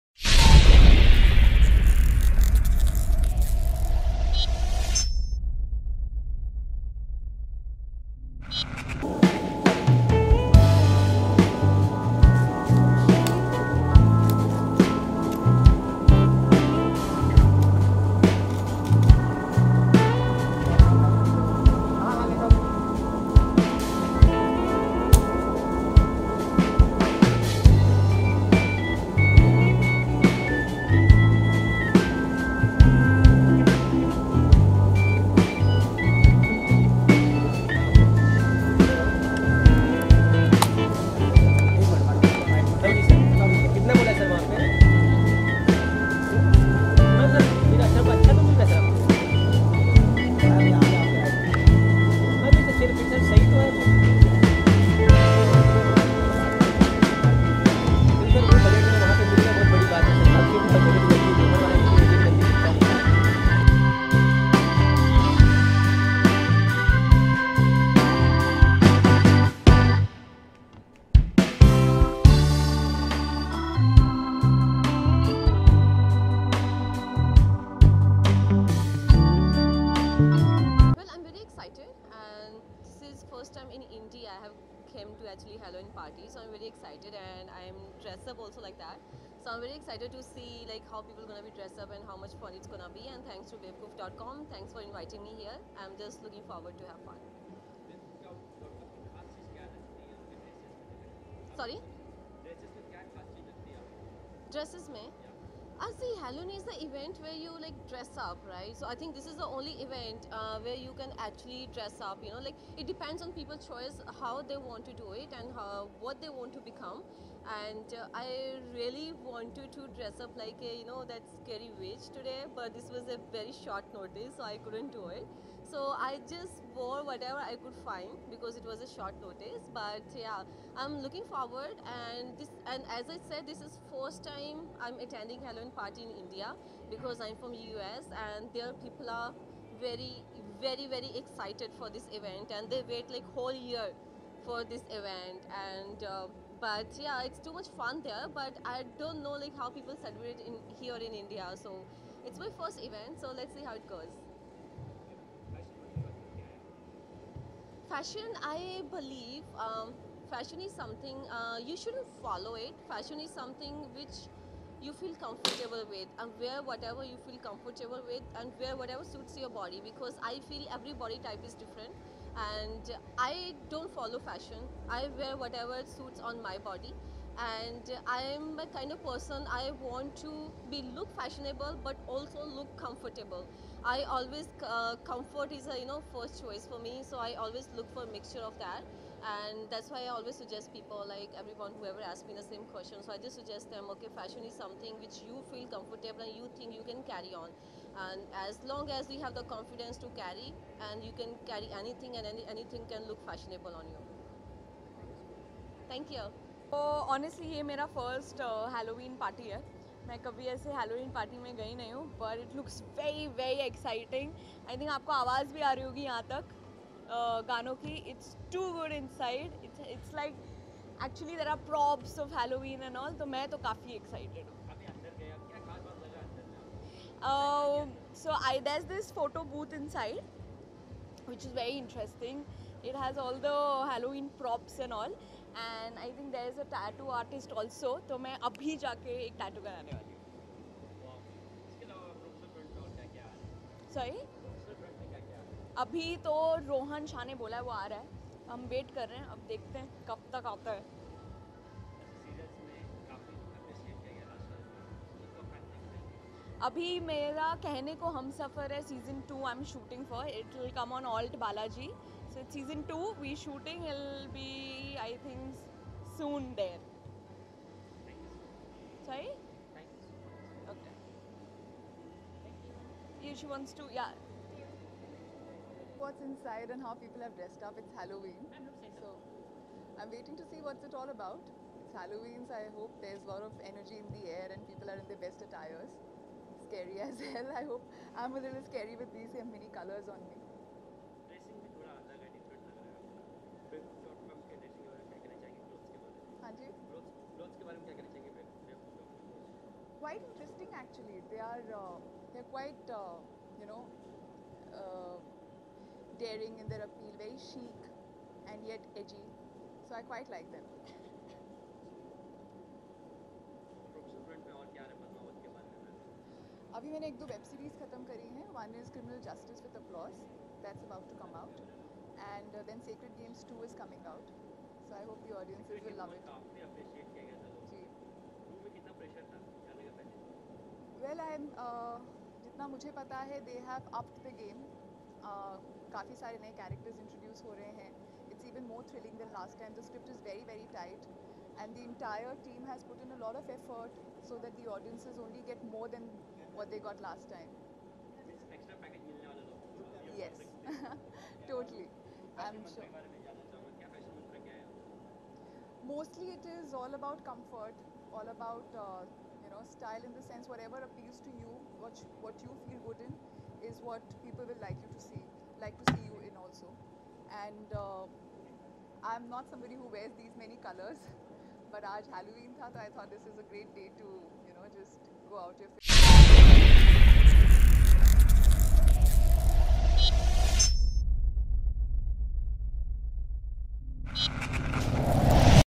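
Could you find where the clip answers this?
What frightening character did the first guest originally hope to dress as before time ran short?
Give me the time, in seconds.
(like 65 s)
121 s.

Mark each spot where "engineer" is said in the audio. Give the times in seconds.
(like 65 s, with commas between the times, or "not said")
not said.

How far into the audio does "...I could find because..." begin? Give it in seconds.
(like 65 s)
127 s.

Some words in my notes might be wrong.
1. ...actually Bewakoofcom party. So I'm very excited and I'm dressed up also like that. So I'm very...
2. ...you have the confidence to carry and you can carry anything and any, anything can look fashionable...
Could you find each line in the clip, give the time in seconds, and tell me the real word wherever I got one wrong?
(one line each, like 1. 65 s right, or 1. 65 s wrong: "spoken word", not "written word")
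1. 85 s wrong: "Halloween", not "Bewakoofcom"
2. 199 s right.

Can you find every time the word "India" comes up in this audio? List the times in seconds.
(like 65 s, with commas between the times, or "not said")
136 s, 151 s.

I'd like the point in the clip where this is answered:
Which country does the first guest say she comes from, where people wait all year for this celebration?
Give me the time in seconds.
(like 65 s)
137 s.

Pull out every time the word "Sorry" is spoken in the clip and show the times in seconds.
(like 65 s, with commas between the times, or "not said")
101 s, 243 s.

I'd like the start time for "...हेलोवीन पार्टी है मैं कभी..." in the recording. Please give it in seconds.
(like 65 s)
208 s.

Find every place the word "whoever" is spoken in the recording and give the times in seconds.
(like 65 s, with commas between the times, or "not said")
191 s.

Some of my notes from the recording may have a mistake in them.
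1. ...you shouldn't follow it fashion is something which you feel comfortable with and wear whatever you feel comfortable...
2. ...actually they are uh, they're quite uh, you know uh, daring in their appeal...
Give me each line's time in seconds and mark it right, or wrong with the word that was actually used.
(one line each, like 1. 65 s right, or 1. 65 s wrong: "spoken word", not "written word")
1. 161 s right
2. 300 s right.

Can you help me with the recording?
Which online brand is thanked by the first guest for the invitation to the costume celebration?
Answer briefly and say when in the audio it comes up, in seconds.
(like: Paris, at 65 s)
Bewakoof.com, at 93 s.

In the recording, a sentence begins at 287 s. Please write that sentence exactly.
I hope I'm a little scary with these mini colors on me.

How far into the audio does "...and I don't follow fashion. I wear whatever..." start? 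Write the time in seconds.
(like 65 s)
172 s.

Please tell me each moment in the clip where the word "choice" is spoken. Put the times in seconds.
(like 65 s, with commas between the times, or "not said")
113 s, 186 s.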